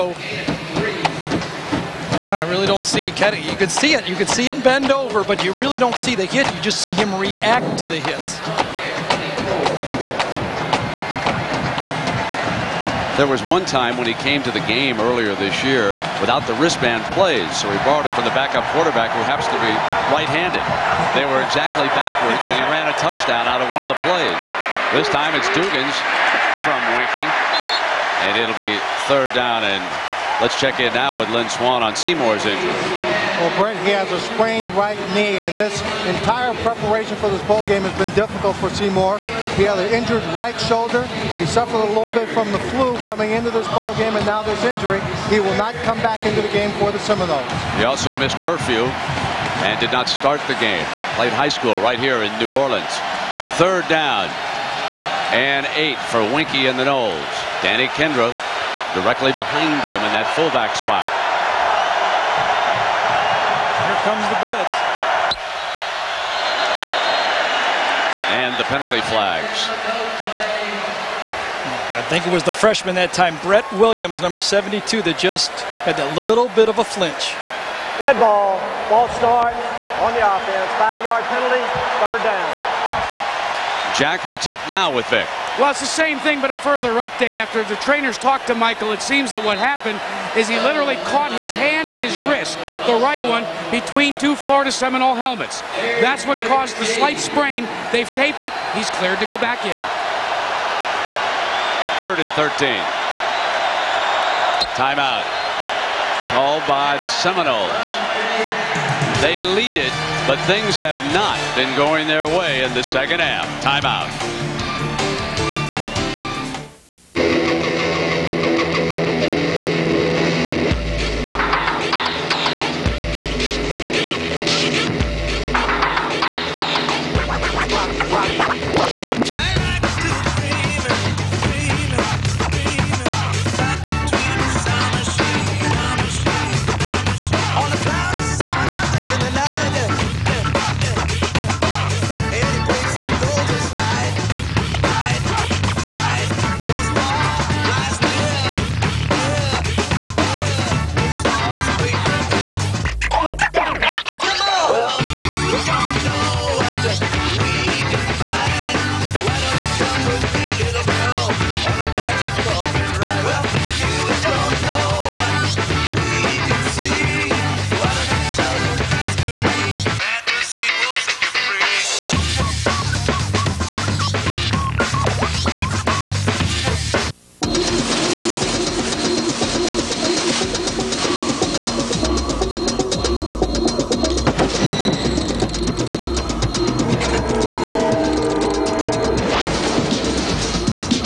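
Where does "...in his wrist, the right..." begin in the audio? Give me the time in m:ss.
1:31.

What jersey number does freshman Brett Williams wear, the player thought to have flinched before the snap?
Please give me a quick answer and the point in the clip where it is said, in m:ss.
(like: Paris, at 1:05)
72, at 1:14.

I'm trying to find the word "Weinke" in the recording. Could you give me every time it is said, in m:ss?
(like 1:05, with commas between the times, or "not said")
0:26, 0:56.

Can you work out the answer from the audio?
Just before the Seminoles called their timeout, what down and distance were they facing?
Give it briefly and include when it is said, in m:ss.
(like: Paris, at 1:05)
Third and 13, at 1:42.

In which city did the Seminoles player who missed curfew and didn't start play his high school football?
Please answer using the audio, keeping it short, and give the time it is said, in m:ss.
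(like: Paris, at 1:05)
New Orleans, at 0:52.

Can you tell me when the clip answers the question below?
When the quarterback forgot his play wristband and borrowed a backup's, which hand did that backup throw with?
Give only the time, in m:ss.
0:20.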